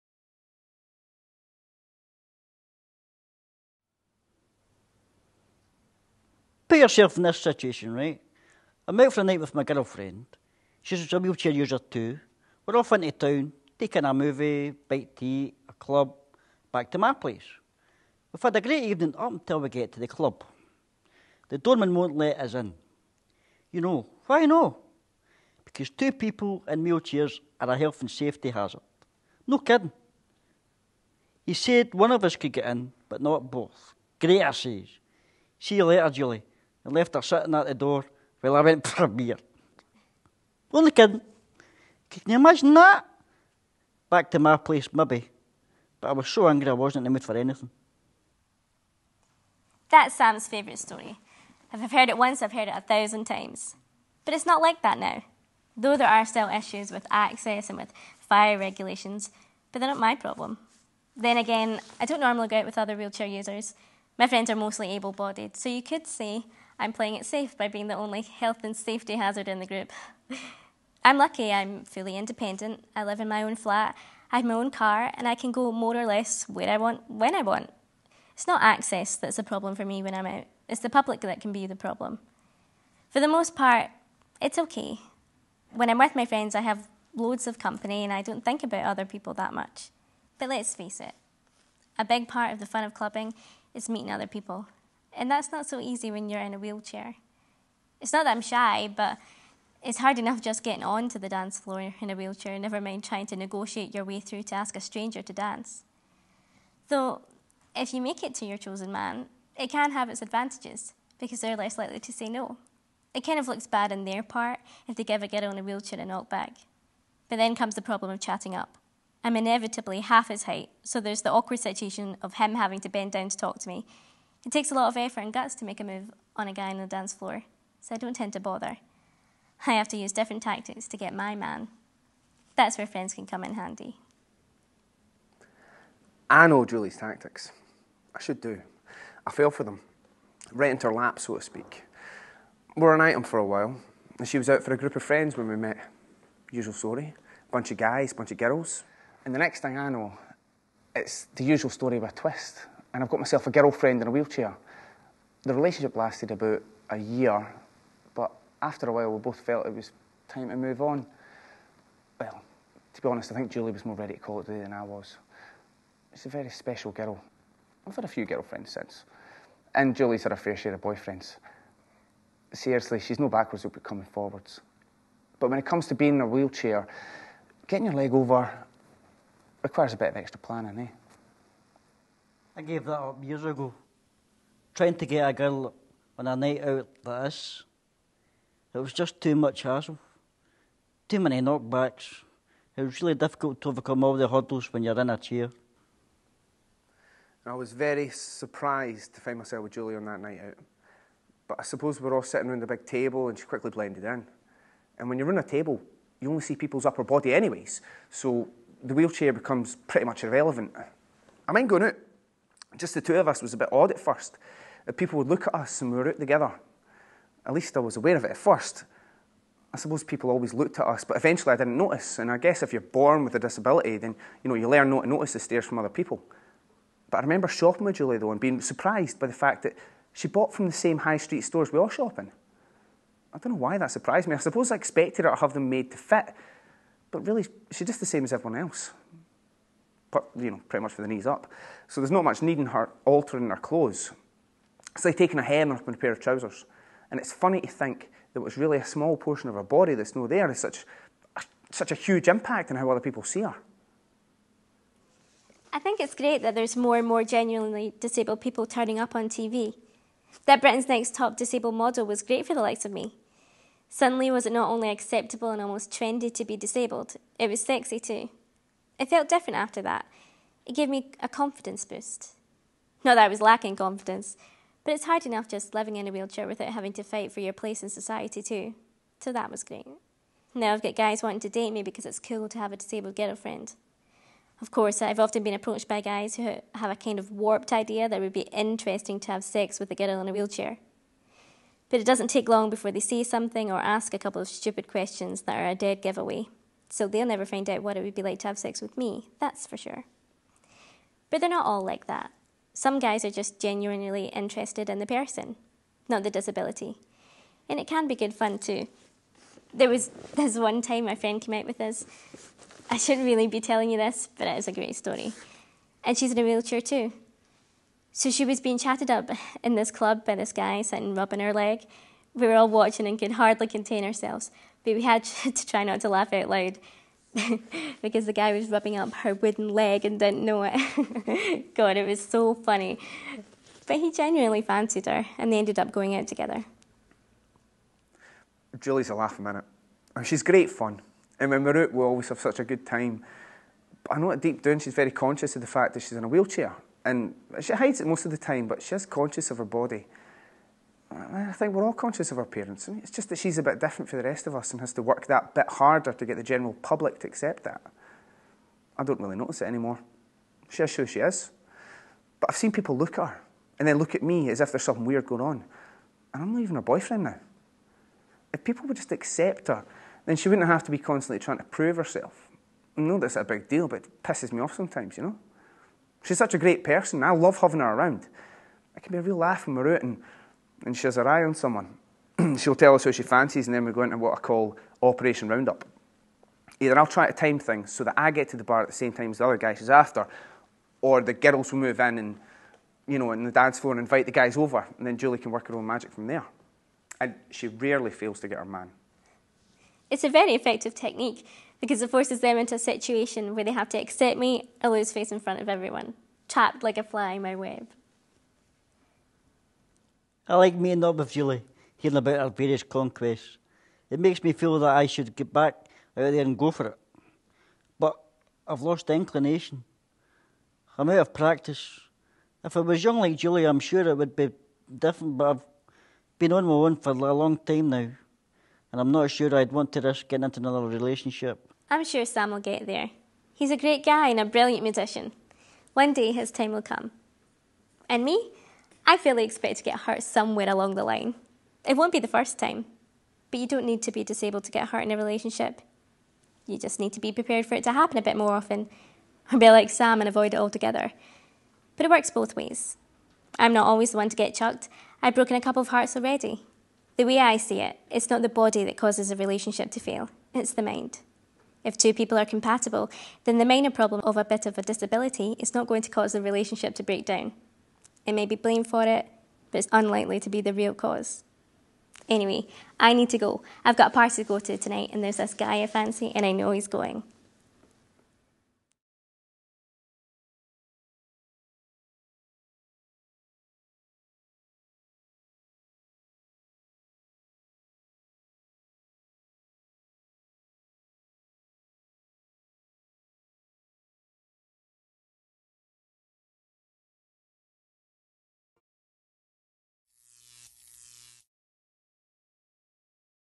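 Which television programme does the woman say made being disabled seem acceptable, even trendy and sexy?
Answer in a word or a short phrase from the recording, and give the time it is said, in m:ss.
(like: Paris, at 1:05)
Britain's Next Top Disabled Model, at 4:20.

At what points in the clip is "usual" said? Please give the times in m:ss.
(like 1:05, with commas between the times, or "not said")
2:26, 2:31.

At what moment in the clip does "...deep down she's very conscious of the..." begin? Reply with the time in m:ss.
5:44.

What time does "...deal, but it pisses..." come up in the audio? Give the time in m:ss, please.
6:13.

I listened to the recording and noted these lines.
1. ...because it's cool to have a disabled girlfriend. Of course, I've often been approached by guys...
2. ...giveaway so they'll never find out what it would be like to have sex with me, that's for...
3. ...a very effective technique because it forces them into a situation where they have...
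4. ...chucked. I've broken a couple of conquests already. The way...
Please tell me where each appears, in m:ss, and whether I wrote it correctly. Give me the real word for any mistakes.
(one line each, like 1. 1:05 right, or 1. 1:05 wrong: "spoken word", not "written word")
1. 4:41 right
2. 4:56 right
3. 6:40 right
4. 7:34 wrong: "hearts", not "conquests".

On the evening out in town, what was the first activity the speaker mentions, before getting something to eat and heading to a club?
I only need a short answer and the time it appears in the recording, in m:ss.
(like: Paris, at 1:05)
a movie, at 0:14.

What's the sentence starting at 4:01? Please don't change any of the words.
So there's not much need in her altering her clothes.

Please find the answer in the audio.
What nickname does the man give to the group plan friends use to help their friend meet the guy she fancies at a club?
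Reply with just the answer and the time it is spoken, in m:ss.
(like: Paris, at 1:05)
Operation Roundup, at 6:25.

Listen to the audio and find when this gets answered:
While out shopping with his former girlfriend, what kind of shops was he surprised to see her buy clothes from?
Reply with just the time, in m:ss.
3:50.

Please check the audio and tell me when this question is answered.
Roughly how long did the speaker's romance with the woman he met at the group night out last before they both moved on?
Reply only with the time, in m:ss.
2:36.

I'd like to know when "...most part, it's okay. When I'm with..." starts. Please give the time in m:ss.
1:23.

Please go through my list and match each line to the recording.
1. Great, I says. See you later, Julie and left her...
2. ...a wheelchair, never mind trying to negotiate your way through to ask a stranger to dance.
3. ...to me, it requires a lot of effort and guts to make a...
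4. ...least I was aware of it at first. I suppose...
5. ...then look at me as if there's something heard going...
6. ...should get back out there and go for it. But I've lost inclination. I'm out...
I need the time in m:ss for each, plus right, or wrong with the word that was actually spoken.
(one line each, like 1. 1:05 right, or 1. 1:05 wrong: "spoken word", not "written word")
1. 0:34 right
2. 1:42 right
3. 2:03 wrong: "takes", not "requires"
4. 3:37 right
5. 6:03 wrong: "weird", not "heard"
6. 6:55 right.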